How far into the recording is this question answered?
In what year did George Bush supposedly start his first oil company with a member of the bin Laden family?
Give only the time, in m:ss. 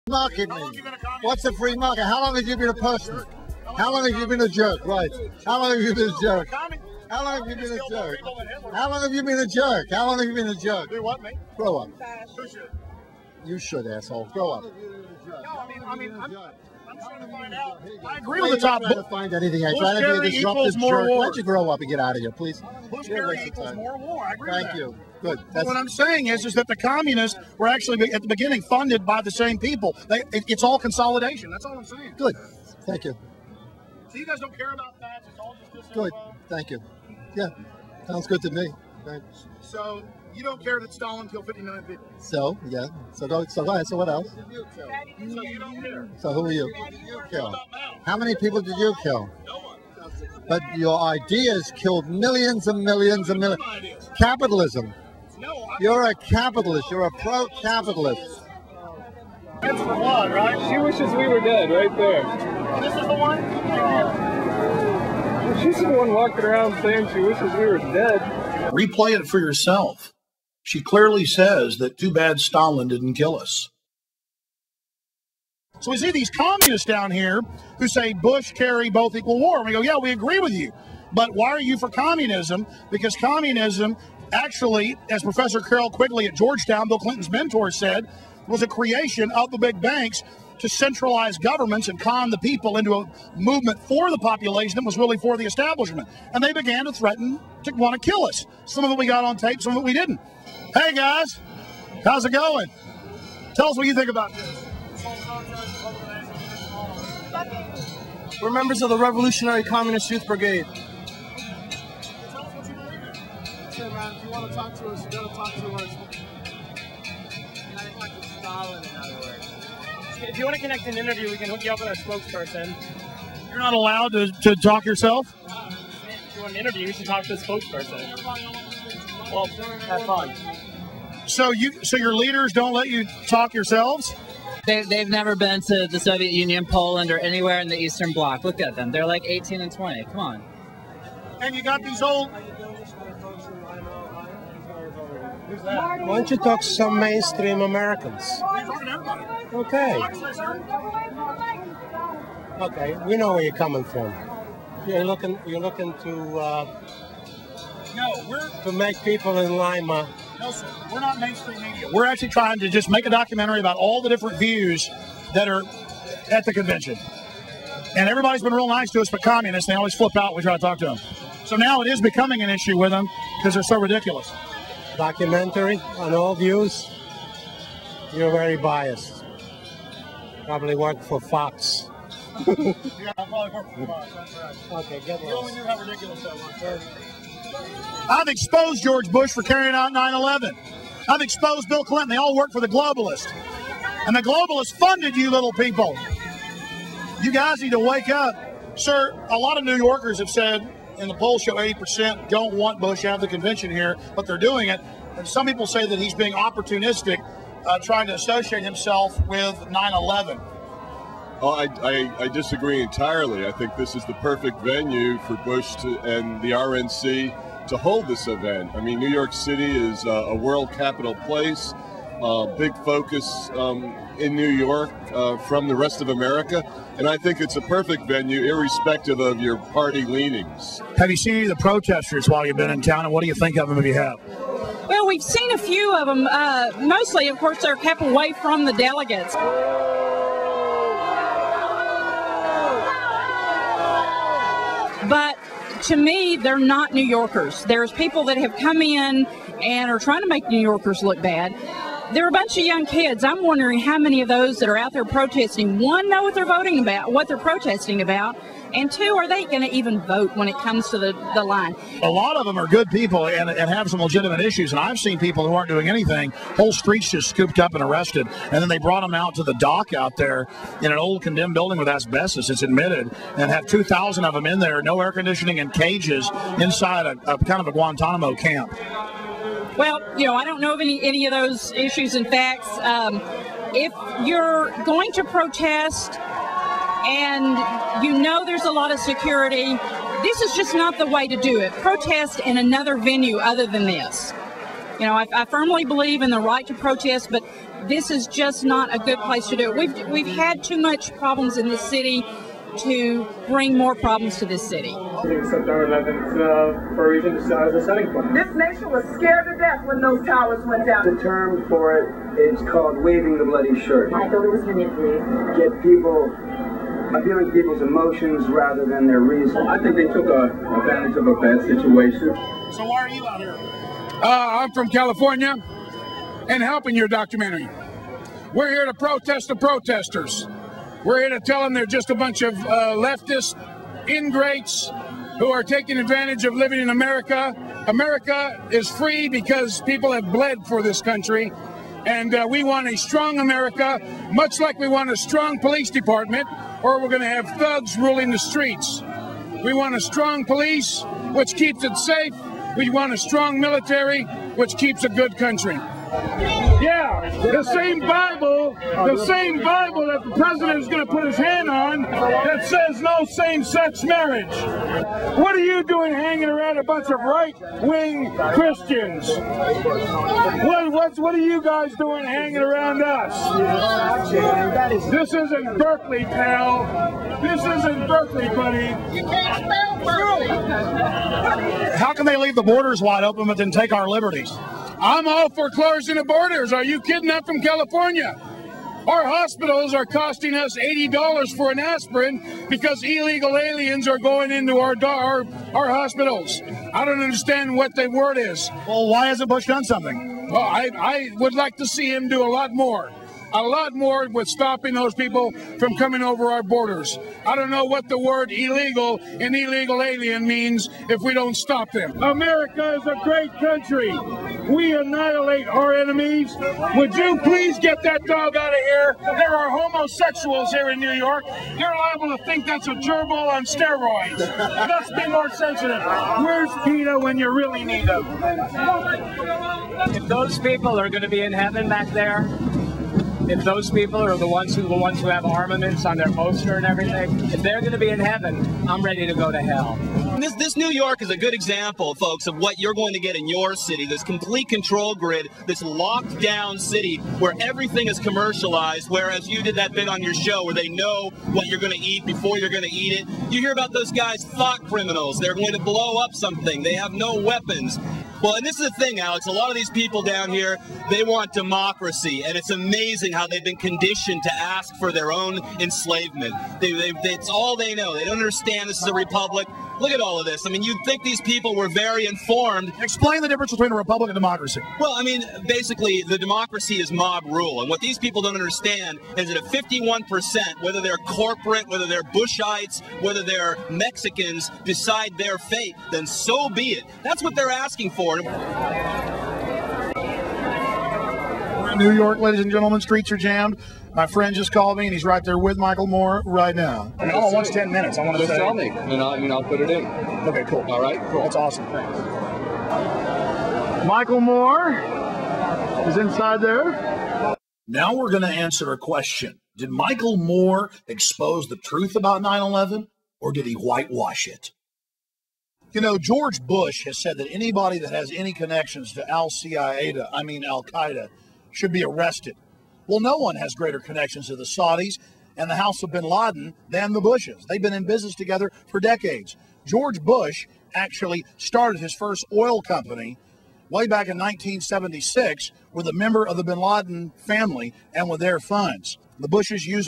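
8:54.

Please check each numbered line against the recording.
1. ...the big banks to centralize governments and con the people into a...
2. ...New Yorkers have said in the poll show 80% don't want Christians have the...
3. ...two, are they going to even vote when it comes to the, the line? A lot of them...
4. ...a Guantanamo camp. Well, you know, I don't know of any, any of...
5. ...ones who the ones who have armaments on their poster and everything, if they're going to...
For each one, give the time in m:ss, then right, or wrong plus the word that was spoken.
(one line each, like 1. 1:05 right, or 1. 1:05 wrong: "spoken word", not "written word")
1. 1:29 right
2. 3:19 wrong: "Bush", not "Christians"
3. 4:18 right
4. 4:37 right
5. 7:14 right.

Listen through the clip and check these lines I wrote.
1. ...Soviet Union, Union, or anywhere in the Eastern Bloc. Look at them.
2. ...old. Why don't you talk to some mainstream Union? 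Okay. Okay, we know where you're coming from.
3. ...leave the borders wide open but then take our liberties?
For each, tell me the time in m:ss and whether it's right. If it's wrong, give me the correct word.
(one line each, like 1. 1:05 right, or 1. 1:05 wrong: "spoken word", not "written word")
1. 2:15 wrong: "Poland", not "Union"
2. 2:22 wrong: "Americans", not "Union"
3. 6:22 right.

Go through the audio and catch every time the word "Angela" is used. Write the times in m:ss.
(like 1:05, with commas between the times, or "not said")
not said.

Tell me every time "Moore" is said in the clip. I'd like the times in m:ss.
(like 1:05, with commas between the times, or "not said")
8:16, 8:24, 8:30.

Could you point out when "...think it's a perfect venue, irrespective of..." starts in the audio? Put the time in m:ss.
3:47.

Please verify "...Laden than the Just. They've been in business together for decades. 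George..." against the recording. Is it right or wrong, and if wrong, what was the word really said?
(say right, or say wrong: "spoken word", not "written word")
wrong: "Bushes", not "Just".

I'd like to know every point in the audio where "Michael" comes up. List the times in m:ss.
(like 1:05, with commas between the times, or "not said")
8:15, 8:24, 8:29.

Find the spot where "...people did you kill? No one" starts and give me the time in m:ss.
0:48.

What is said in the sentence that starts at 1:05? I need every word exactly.
She's the one walking around saying she wishes we were dead.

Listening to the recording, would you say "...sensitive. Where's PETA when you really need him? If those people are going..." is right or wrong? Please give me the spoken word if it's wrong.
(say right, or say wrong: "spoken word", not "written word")
right.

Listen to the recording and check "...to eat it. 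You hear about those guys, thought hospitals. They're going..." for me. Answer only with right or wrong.
wrong.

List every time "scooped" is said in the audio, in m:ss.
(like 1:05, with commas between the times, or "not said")
4:27.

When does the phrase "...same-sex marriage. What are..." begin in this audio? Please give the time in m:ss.
6:03.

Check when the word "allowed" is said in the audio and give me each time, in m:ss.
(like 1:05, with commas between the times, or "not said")
2:03.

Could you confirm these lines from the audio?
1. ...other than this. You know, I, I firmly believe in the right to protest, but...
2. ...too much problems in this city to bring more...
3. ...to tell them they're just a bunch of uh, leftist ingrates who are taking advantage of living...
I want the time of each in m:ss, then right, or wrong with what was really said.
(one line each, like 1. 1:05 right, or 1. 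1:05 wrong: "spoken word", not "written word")
1. 4:53 right
2. 5:00 right
3. 5:31 right.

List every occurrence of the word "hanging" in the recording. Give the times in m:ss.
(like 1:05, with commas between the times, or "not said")
6:06, 6:12.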